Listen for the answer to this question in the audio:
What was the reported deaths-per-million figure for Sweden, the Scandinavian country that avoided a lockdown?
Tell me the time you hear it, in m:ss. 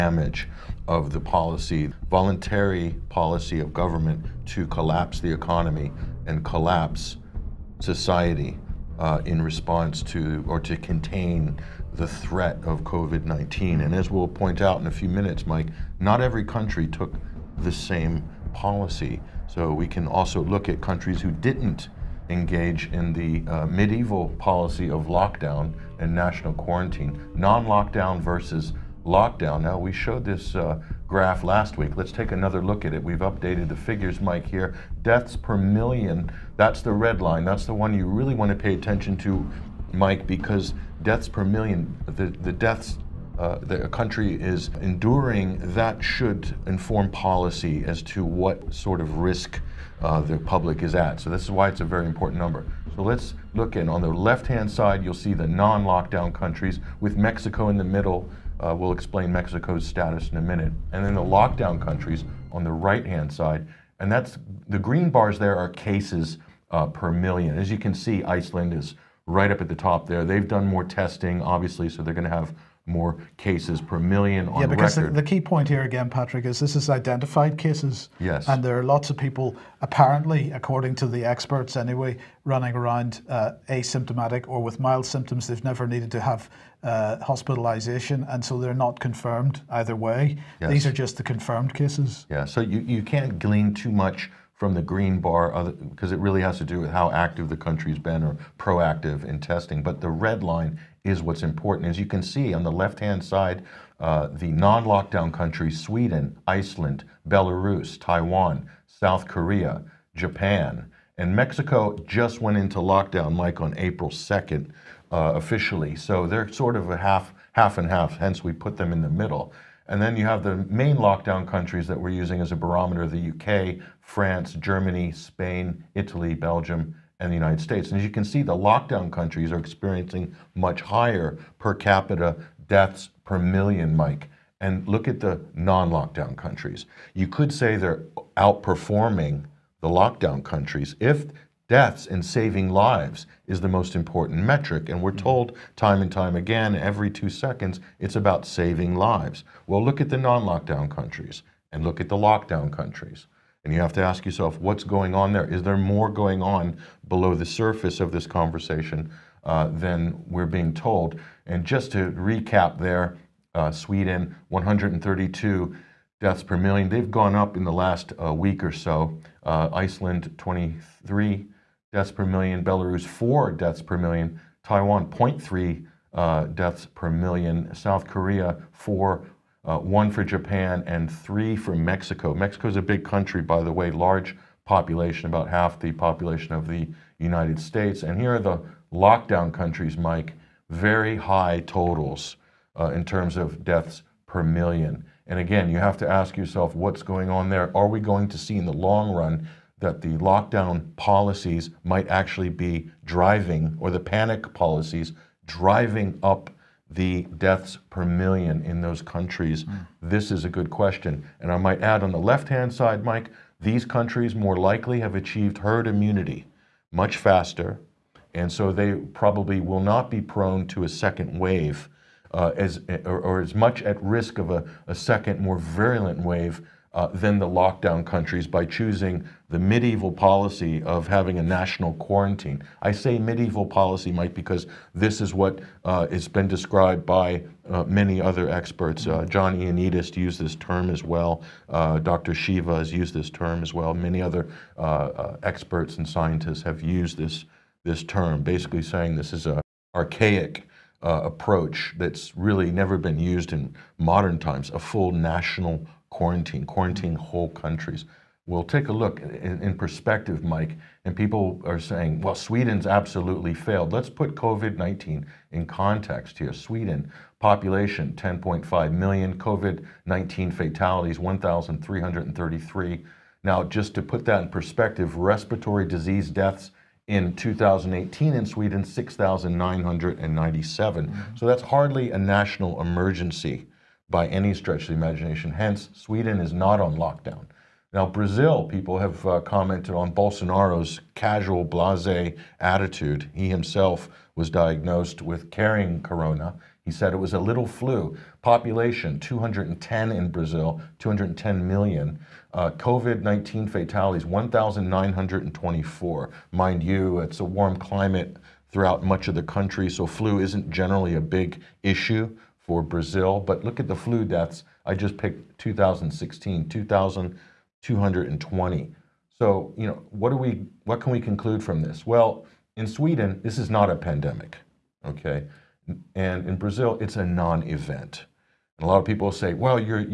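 2:44.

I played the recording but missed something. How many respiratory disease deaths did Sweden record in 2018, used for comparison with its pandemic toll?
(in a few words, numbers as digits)
6,997.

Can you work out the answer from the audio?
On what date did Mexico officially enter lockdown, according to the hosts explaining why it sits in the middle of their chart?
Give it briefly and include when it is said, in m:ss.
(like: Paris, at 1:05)
April 2nd, at 1:53.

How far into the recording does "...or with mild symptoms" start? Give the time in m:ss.
1:24.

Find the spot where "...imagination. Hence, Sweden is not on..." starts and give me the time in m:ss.
4:44.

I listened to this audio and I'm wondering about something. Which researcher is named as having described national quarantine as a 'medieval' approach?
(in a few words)
John Ioannidis.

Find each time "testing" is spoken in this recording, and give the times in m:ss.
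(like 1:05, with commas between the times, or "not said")
1:10, 1:39.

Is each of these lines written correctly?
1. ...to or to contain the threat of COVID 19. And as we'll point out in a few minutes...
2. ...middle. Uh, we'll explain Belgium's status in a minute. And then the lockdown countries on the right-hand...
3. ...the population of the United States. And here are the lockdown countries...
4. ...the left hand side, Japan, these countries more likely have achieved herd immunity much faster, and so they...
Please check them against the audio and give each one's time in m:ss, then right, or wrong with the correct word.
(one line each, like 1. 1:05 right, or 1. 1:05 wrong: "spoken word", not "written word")
1. 0:10 right
2. 0:57 wrong: "Mexico", not "Belgium"
3. 3:05 right
4. 3:32 wrong: "Mike", not "Japan".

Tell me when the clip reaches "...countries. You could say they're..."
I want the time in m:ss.
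2:16.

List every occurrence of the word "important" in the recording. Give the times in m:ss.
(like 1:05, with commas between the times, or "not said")
0:52, 1:41, 2:23.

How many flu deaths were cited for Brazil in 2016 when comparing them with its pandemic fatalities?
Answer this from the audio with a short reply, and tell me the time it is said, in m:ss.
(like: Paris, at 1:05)
2,220, at 5:16.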